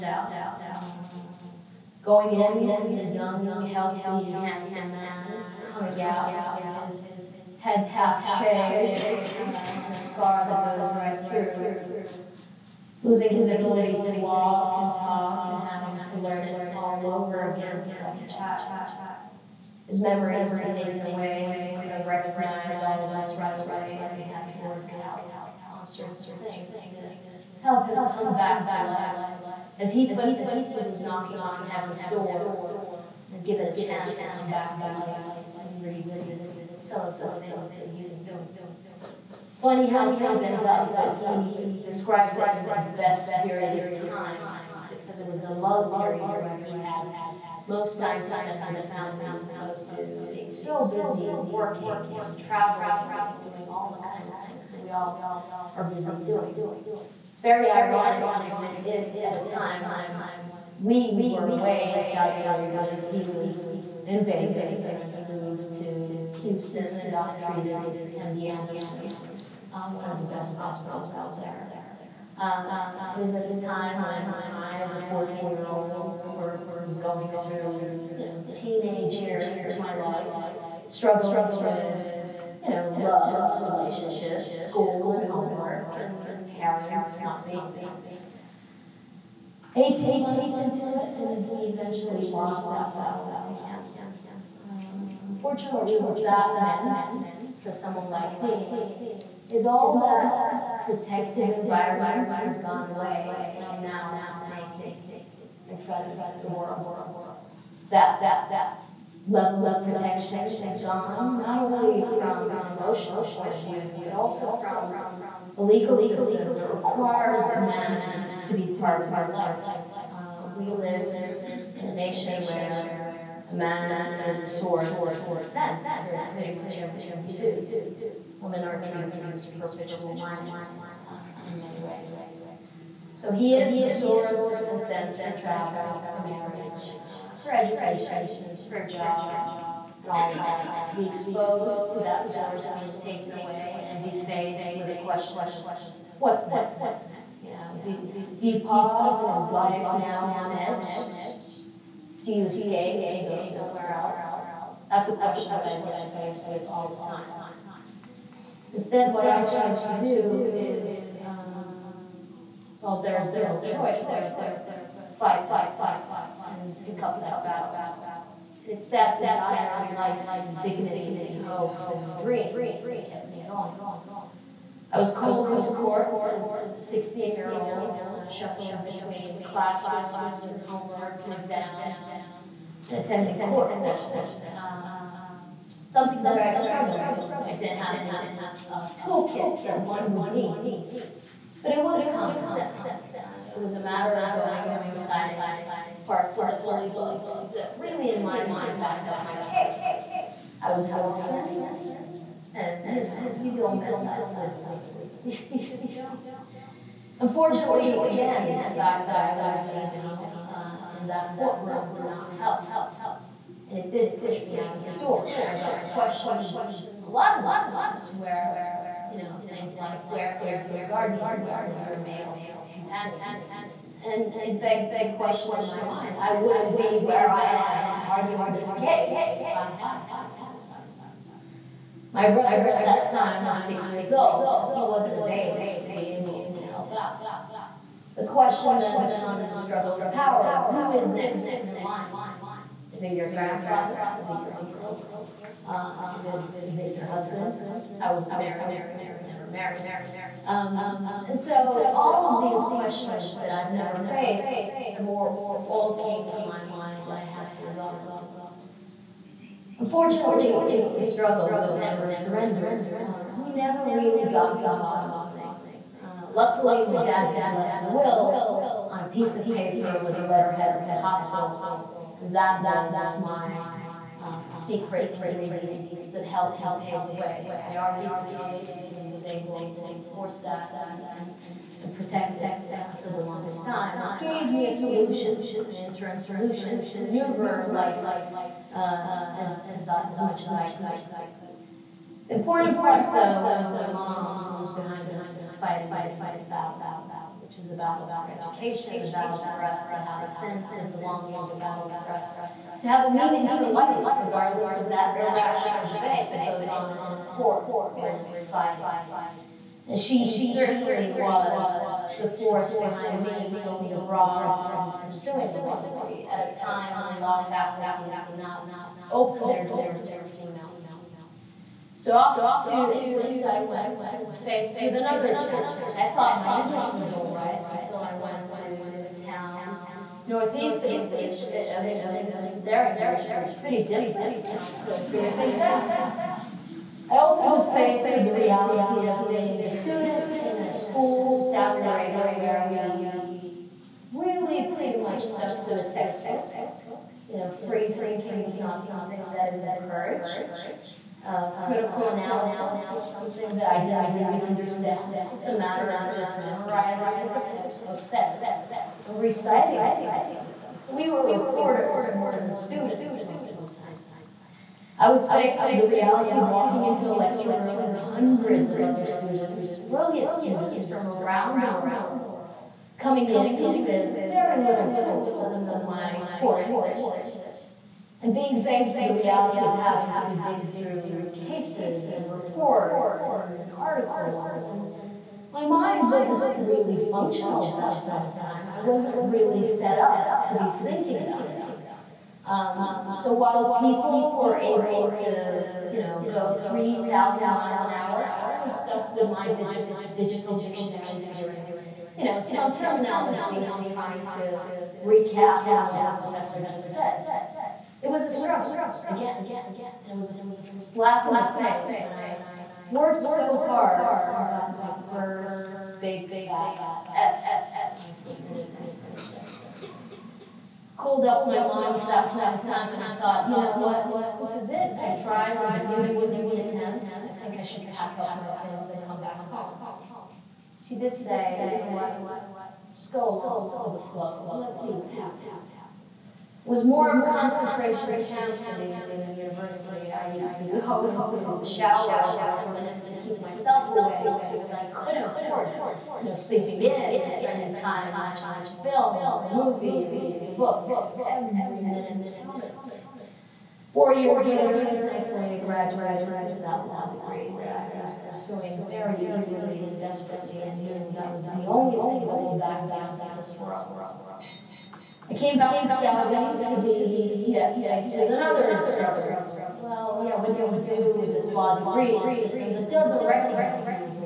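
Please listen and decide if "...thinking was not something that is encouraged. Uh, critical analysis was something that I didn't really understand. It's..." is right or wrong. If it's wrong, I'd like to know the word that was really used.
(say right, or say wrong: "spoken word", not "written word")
right.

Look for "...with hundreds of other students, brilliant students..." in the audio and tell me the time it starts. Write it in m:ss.
6:07.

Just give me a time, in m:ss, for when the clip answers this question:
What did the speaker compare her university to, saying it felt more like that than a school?
7:17.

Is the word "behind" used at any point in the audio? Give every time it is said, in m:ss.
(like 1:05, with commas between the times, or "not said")
4:54, 5:12.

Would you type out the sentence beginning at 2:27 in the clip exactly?
You know, do, do you pause and is life now on edge?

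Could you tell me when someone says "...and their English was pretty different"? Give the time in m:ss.
5:32.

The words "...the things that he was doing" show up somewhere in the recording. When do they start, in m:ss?
0:37.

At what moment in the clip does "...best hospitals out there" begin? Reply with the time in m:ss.
1:10.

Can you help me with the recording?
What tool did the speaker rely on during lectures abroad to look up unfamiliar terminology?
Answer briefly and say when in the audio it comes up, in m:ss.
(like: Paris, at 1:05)
Digital dictionary, at 6:40.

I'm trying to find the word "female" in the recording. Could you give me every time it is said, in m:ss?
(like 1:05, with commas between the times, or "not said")
3:29, 5:20.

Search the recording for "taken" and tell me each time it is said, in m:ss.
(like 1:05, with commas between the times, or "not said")
0:20, 2:23.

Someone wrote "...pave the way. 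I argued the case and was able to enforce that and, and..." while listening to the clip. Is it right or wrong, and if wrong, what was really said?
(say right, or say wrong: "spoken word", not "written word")
right.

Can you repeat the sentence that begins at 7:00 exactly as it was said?
Called up my mom at that point in time and I thought, you know what, this is it.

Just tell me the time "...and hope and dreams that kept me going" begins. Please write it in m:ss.
2:51.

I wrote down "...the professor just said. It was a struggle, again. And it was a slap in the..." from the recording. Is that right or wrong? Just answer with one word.
right.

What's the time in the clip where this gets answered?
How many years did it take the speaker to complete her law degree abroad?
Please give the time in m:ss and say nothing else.
7:33.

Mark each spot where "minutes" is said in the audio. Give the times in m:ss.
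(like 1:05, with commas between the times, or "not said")
7:22, 7:31.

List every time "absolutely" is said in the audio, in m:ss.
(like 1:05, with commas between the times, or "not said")
not said.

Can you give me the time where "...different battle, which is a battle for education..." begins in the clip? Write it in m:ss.
4:56.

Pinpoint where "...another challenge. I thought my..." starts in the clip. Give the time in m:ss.
5:24.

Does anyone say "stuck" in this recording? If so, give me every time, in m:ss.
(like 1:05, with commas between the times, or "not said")
5:45, 6:38.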